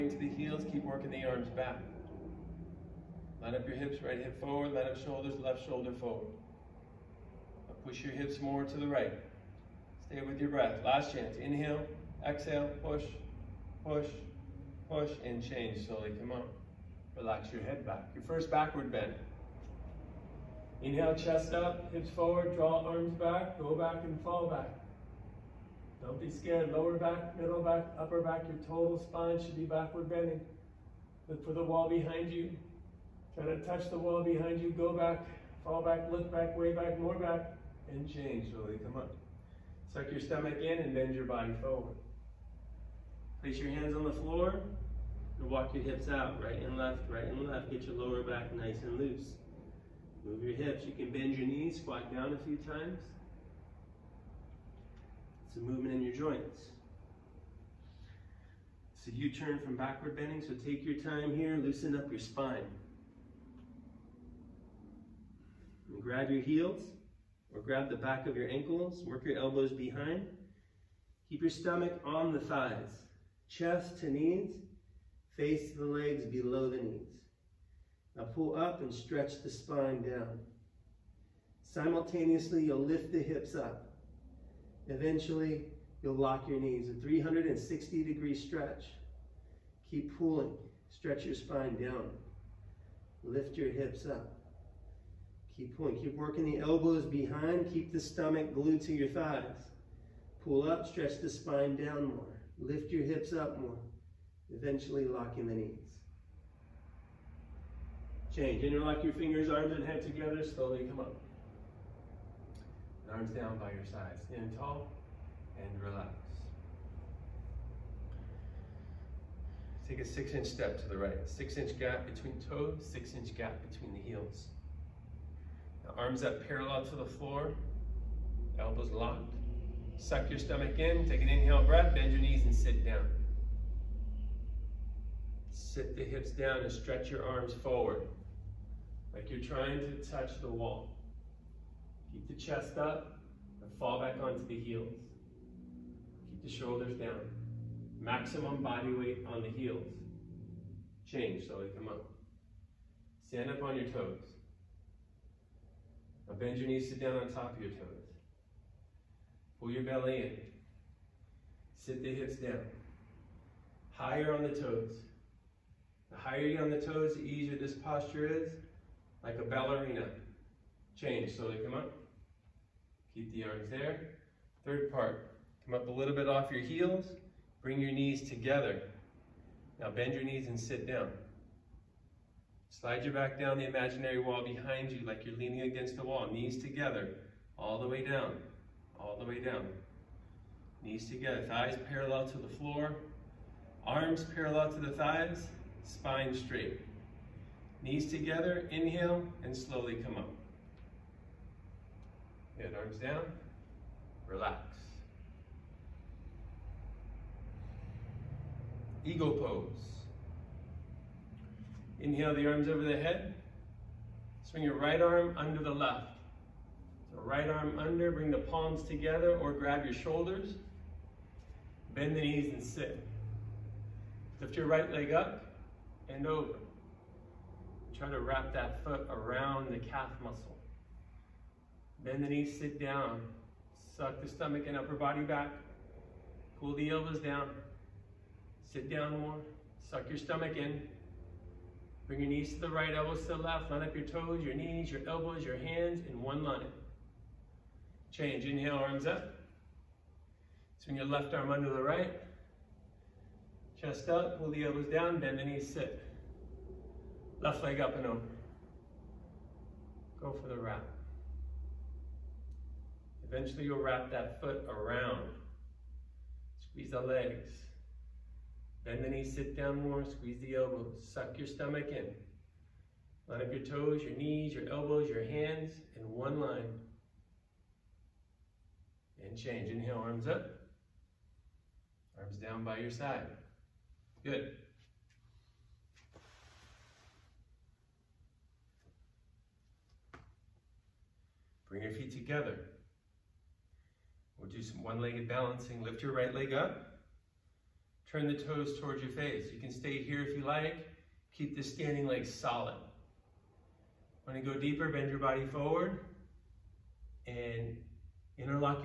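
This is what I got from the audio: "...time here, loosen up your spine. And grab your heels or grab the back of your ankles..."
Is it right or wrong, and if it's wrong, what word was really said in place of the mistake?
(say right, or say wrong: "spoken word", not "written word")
right.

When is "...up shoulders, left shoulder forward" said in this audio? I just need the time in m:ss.
0:04.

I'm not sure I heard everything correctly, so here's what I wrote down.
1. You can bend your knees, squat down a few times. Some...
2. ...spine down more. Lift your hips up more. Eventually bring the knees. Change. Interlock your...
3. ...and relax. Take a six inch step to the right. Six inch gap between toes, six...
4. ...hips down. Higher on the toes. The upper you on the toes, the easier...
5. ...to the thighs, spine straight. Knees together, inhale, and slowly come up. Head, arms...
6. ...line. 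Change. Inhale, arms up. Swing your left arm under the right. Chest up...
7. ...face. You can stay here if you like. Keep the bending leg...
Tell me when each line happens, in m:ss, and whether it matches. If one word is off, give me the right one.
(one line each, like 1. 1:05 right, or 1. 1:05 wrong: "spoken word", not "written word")
1. 0:50 right
2. 1:41 wrong: "locking", not "bring"
3. 1:55 right
4. 2:42 wrong: "higher", not "upper"
5. 3:14 right
6. 4:06 right
7. 4:59 wrong: "standing", not "bending".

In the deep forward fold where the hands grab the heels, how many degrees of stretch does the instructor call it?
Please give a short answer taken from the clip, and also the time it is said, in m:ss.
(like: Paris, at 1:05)
360, at 1:26.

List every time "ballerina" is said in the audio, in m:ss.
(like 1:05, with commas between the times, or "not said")
2:49.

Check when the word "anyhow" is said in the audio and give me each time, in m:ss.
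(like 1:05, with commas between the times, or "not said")
not said.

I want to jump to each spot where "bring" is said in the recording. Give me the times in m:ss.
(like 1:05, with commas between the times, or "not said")
2:57, 3:38, 4:02, 4:51.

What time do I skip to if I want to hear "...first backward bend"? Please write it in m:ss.
0:18.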